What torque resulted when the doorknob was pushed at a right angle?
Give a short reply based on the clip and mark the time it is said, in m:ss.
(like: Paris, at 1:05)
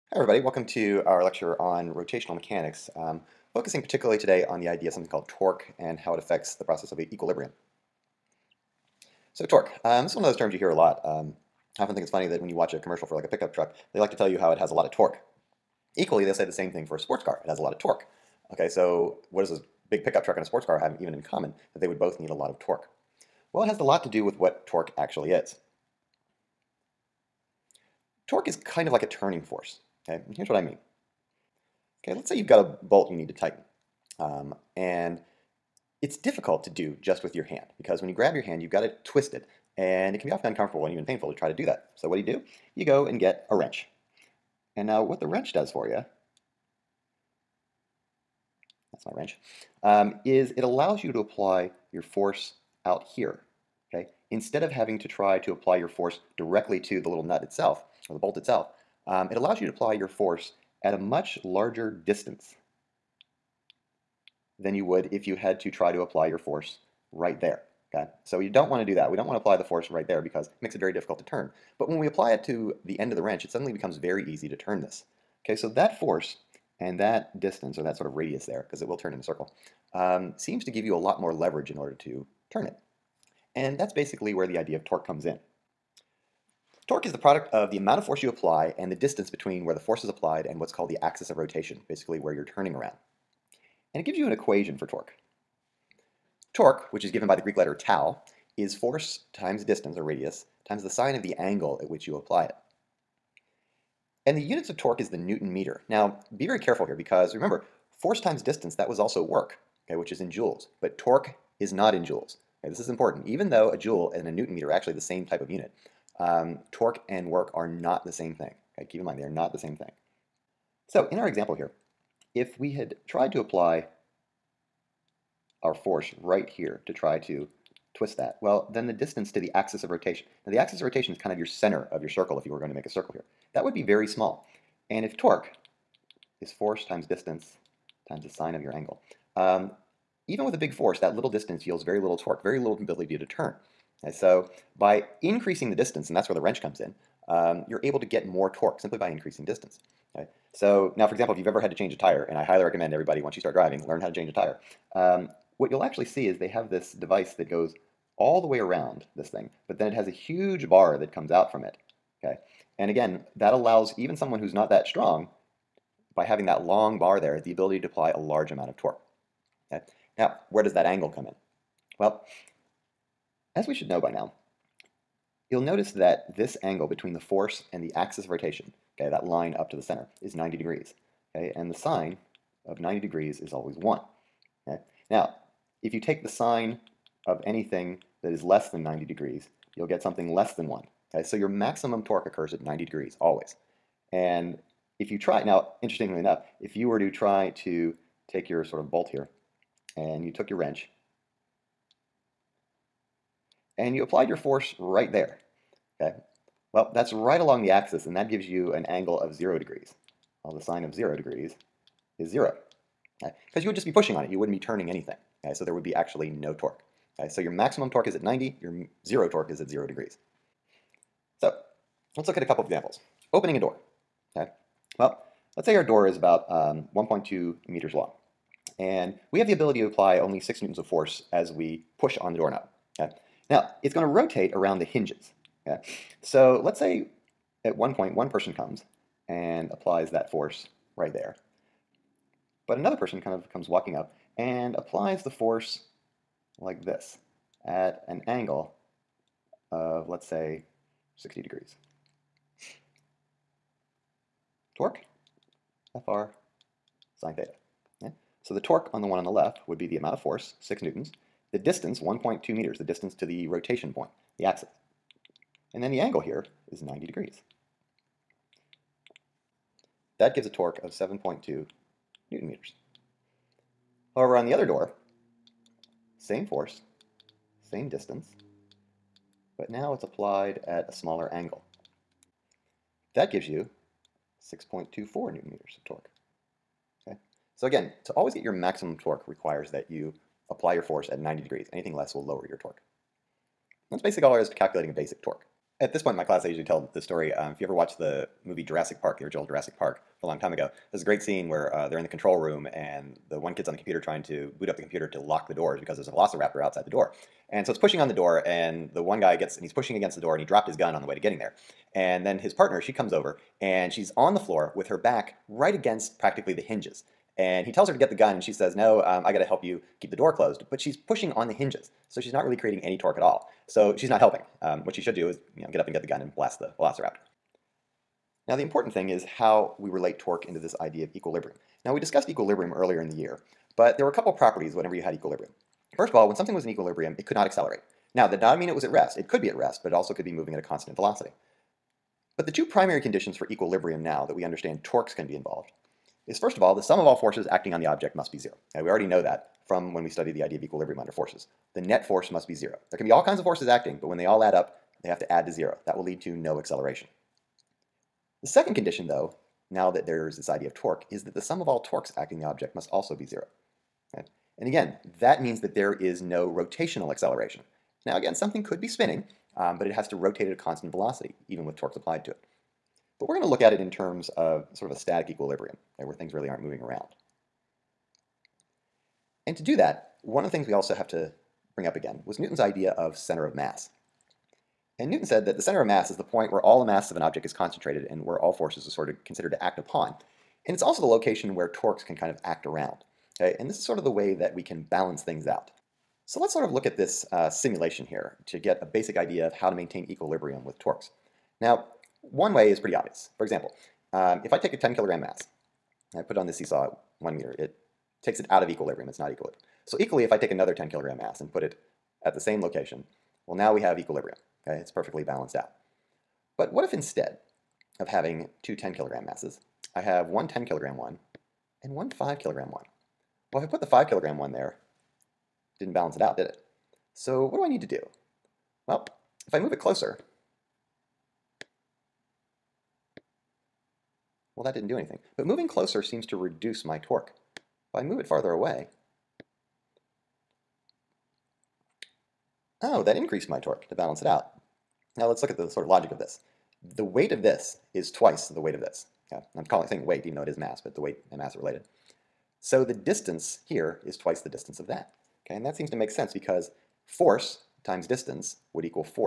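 7.2 newton meters, at 4:30.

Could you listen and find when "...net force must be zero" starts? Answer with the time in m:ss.
5:51.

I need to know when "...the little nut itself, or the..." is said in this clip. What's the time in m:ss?
0:57.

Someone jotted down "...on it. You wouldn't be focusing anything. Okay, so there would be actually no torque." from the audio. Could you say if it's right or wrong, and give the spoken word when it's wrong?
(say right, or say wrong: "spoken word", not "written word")
wrong: "turning", not "focusing".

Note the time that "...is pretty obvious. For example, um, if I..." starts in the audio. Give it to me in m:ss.
6:42.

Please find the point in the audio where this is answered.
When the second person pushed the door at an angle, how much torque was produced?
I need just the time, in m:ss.
4:44.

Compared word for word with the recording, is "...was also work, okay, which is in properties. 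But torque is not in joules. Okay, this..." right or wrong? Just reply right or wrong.
wrong.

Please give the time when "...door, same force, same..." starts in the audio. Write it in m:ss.
4:34.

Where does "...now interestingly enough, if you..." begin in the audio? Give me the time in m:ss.
3:15.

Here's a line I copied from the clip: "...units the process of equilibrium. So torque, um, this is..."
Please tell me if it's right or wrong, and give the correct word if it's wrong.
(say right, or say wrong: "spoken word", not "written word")
wrong: "affects", not "units".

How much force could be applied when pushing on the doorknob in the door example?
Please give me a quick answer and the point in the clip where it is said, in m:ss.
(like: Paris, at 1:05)
6 newtons, at 3:50.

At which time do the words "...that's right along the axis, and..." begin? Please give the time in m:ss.
3:26.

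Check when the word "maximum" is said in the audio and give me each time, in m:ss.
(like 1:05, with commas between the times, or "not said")
3:11, 3:37, 4:48.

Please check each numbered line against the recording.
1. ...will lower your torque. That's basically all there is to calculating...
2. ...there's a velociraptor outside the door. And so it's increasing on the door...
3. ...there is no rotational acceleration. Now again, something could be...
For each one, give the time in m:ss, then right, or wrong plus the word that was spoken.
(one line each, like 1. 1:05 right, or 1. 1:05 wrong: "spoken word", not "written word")
1. 4:52 right
2. 5:05 wrong: "pushing", not "increasing"
3. 6:05 right.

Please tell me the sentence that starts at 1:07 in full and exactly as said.
Okay, So you don't want to do that.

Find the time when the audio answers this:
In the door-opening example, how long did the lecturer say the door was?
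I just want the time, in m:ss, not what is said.
3:46.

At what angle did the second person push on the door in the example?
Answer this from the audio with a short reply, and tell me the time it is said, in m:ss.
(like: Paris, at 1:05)
60 degrees, at 4:11.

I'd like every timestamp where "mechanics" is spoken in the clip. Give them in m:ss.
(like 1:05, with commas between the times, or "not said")
0:02.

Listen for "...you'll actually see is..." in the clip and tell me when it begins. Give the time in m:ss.
2:35.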